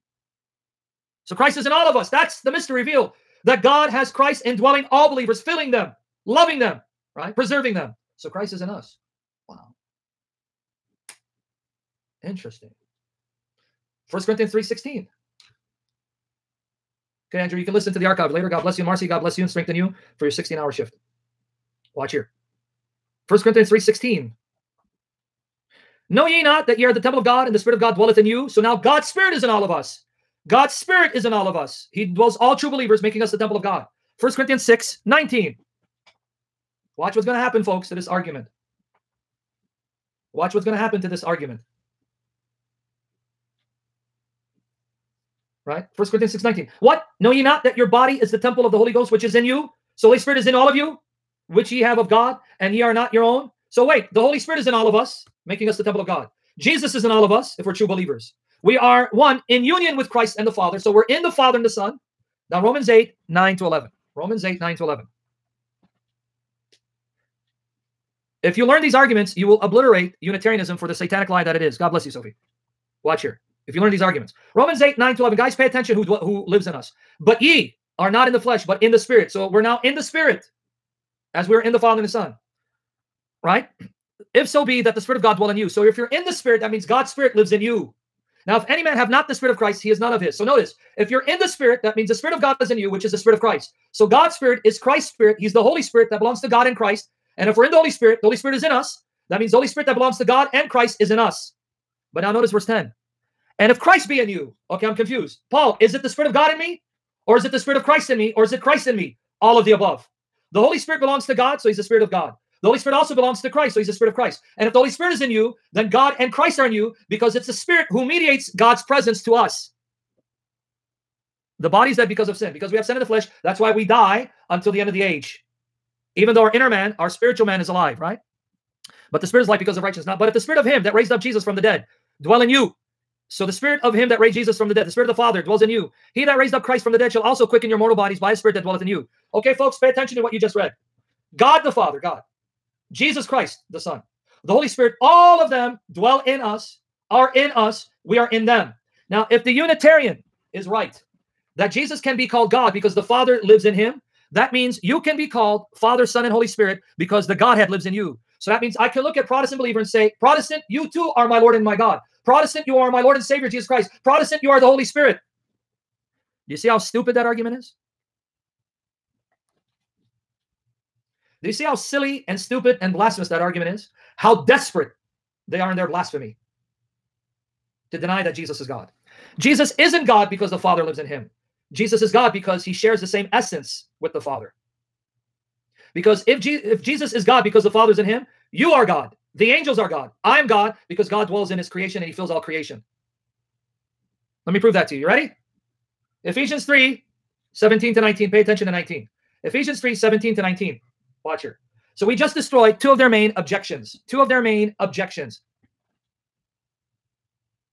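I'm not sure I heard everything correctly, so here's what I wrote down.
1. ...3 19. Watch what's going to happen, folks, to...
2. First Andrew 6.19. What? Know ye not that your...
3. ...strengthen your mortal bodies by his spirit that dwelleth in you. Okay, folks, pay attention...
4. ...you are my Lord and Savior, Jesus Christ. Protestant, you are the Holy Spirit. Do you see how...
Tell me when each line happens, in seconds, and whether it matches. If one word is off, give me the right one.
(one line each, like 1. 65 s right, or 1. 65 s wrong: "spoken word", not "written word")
1. 34 s wrong: "6", not "3"
2. 45 s wrong: "Corinthians", not "Andrew"
3. 137 s wrong: "quicken", not "strengthen"
4. 162 s right.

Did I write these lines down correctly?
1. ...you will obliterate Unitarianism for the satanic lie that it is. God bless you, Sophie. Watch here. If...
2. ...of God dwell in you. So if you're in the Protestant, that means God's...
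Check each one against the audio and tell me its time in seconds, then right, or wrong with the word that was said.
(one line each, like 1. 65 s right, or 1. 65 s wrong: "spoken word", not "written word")
1. 69 s right
2. 85 s wrong: "Spirit", not "Protestant".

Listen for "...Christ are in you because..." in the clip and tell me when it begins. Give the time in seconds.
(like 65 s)
116 s.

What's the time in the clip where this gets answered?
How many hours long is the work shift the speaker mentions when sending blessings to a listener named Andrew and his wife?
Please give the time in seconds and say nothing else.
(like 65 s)
20 s.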